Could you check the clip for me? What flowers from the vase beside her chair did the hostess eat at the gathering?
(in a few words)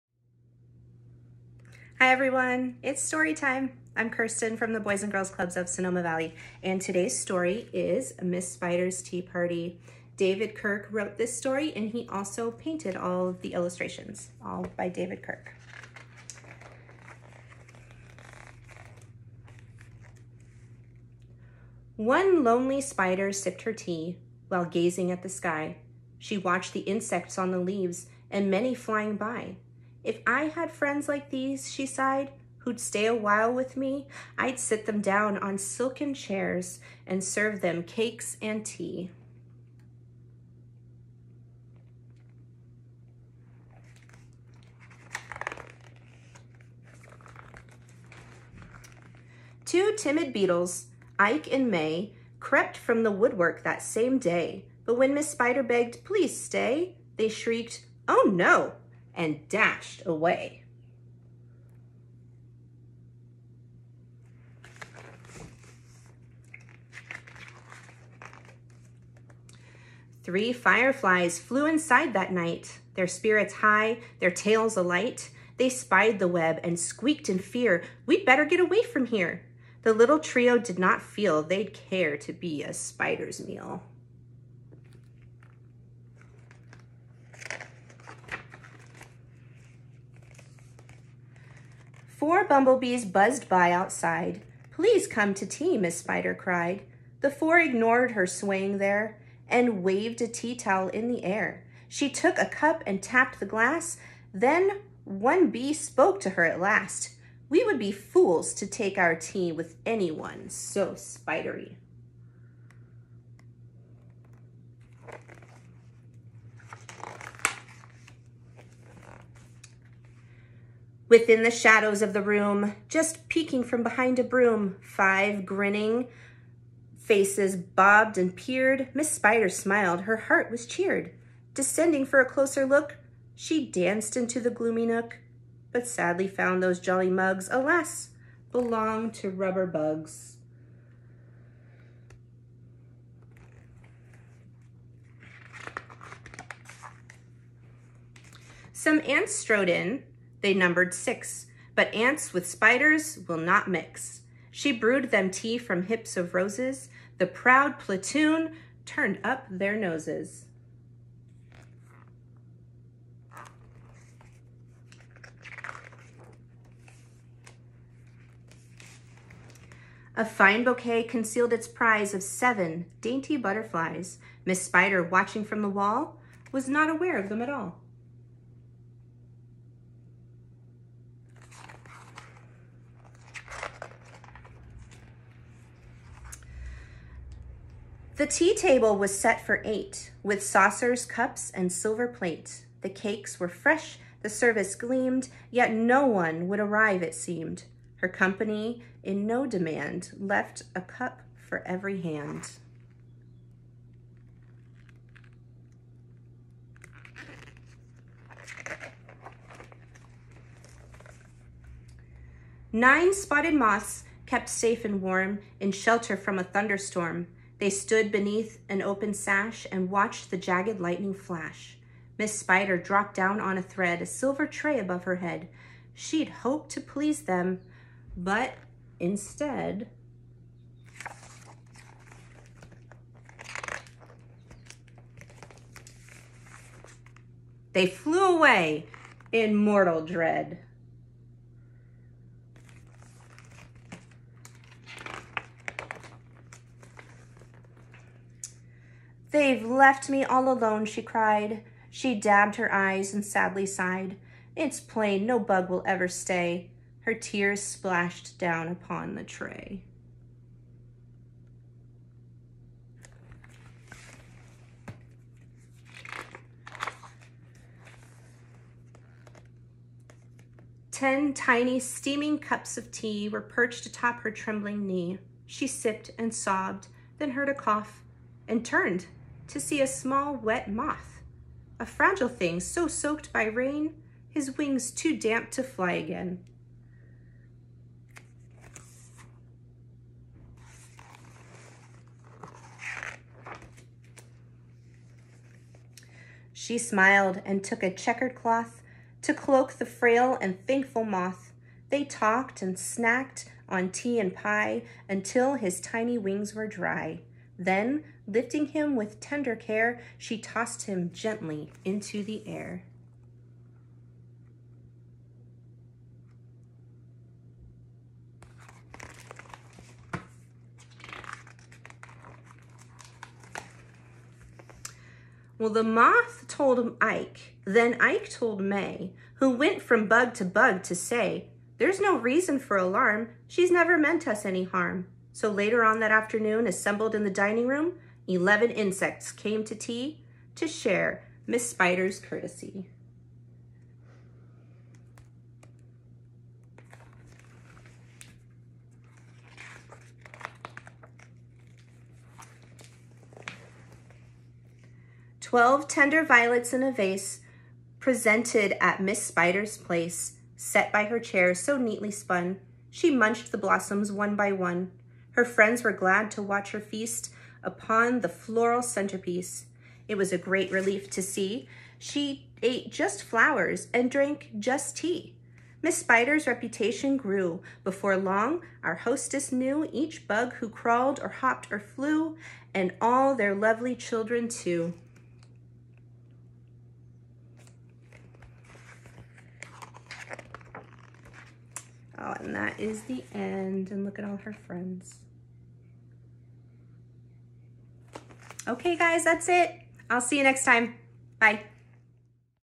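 violets.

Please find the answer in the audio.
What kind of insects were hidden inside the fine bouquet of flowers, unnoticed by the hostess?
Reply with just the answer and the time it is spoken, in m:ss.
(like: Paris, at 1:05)
butterflies, at 2:53.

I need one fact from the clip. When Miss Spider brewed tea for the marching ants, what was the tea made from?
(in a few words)
hips of roses.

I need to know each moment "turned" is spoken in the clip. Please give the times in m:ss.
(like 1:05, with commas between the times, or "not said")
2:38, 4:38.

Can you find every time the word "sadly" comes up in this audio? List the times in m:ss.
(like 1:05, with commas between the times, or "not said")
2:15, 4:13.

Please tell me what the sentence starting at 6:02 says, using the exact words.
She munched the blossoms one by one.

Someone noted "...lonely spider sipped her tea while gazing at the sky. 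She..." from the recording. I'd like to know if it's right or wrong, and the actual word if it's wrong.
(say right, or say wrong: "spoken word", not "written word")
right.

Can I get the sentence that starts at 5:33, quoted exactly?
She's never meant us any harm.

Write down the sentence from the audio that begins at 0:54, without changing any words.
But when Miss Spider begged, please stay, they shrieked, oh no, and dashed away.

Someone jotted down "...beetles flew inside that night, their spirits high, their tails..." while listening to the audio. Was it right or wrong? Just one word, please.
wrong.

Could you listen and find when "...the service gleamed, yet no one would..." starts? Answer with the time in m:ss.
3:14.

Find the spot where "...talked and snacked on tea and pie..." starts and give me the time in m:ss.
5:02.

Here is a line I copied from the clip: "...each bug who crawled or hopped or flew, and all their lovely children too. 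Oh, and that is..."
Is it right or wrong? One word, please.
right.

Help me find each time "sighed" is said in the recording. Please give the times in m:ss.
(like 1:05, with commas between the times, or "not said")
0:31, 4:13.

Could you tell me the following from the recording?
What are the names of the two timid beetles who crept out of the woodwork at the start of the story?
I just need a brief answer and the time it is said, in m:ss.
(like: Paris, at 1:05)
Ike and May, at 0:51.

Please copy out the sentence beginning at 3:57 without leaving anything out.
They flew away in mortal dread.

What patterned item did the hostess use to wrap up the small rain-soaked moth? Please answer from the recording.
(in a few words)
checkered cloth.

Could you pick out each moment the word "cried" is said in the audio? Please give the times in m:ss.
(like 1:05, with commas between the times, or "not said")
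1:36, 4:11.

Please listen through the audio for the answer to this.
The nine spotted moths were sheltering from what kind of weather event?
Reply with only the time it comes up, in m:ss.
3:36.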